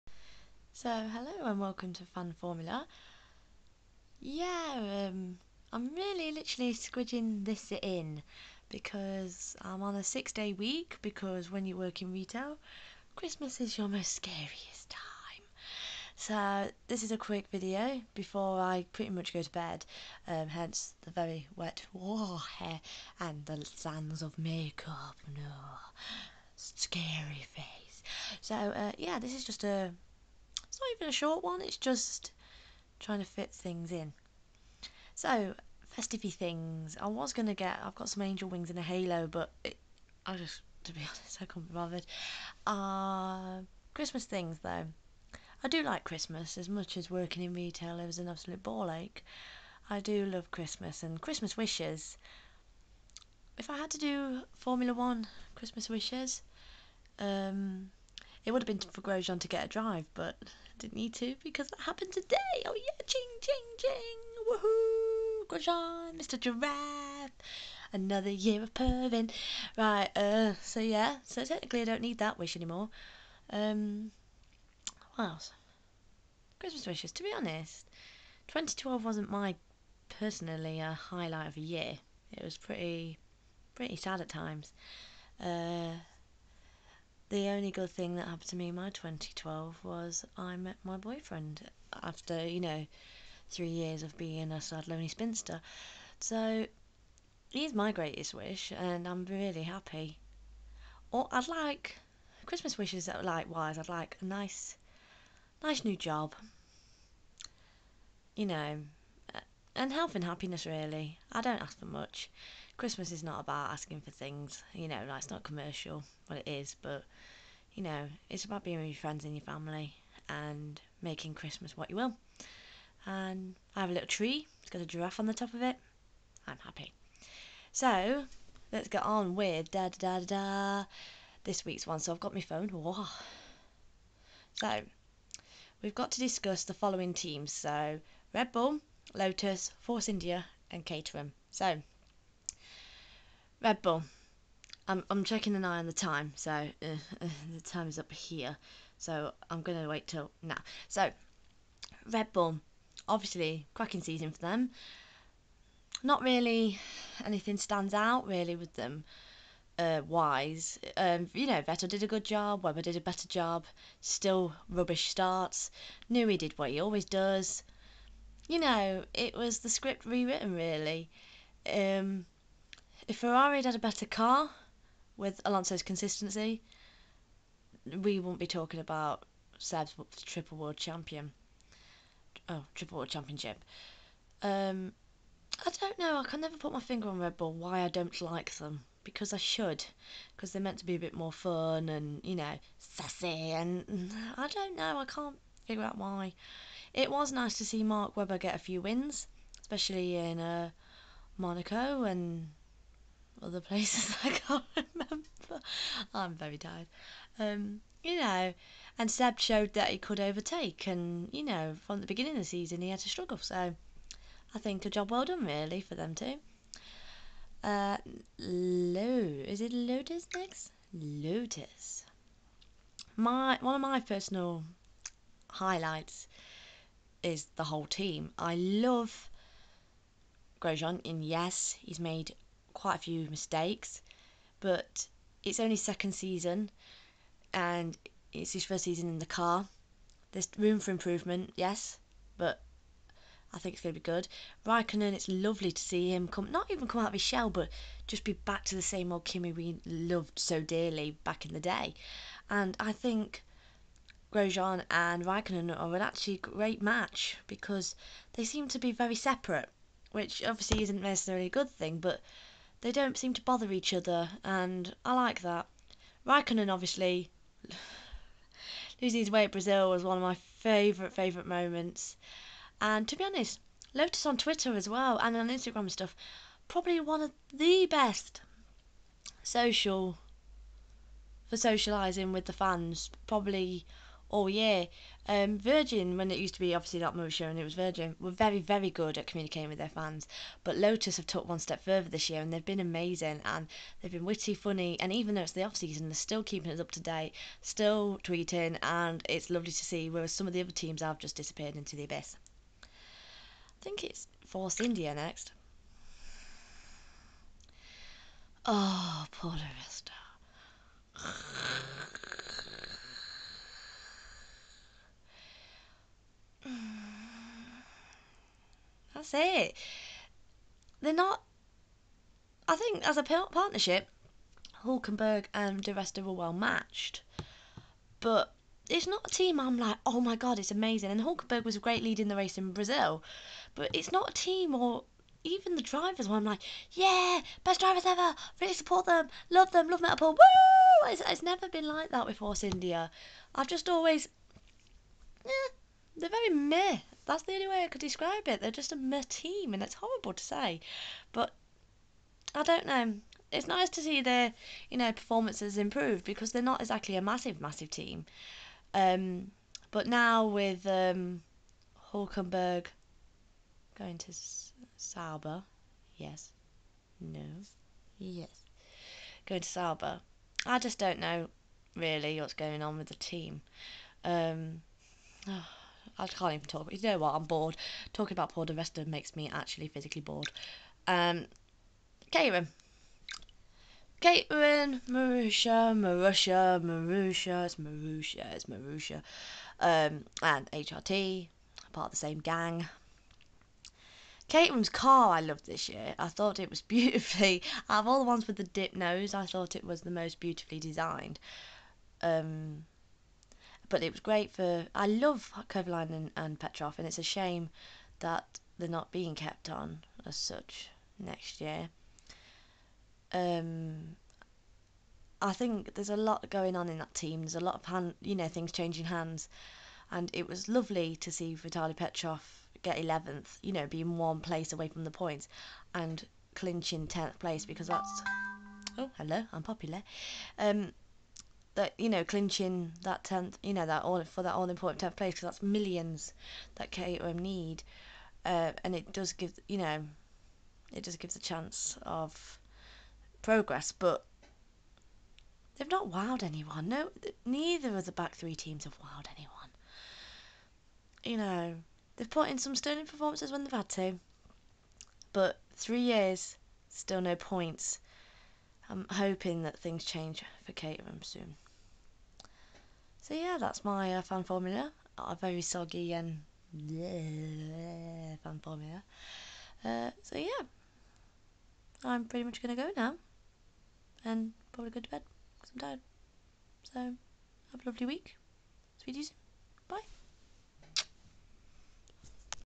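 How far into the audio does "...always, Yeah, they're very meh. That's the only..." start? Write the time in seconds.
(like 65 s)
343 s.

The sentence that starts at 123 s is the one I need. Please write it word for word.
And I have a little tree.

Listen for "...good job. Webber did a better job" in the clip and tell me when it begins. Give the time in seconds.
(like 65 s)
162 s.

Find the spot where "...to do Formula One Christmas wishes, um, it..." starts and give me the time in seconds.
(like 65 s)
53 s.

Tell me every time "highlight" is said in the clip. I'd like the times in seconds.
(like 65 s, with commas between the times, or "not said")
80 s, 225 s.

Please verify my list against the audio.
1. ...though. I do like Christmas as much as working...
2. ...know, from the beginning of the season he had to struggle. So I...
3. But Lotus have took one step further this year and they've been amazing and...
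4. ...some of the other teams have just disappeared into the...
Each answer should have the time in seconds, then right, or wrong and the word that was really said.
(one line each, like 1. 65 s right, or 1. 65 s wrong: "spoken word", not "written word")
1. 44 s right
2. 211 s right
3. 290 s right
4. 300 s right.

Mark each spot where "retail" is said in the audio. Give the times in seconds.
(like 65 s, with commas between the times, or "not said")
12 s, 47 s.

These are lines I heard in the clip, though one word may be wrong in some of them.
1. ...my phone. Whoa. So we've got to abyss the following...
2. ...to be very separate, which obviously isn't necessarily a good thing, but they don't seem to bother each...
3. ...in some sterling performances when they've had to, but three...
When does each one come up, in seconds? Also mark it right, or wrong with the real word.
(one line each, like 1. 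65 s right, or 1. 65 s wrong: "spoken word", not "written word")
1. 132 s wrong: "discuss", not "abyss"
2. 258 s right
3. 452 s right.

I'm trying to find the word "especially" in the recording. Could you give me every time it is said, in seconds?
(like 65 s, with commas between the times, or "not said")
199 s.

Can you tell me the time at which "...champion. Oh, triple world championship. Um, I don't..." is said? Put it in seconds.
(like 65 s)
180 s.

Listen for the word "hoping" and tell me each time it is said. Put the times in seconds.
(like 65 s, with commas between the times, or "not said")
459 s.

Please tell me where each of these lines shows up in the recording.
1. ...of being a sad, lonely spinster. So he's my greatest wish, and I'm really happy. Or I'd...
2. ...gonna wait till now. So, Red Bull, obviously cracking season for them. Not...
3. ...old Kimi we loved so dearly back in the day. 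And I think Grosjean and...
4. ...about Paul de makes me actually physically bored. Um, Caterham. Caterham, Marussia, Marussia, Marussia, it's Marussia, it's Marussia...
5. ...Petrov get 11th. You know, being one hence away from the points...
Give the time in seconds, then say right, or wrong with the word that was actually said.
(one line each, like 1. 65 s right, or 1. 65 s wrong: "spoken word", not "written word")
1. 94 s right
2. 149 s right
3. 249 s right
4. 378 s right
5. 421 s wrong: "place", not "hence".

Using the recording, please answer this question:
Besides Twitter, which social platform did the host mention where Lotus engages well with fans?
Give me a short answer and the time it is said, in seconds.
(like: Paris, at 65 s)
Instagram, at 275 s.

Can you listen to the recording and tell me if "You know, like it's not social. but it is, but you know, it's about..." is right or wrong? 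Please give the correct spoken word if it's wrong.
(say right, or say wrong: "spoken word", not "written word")
wrong: "commercial", not "social".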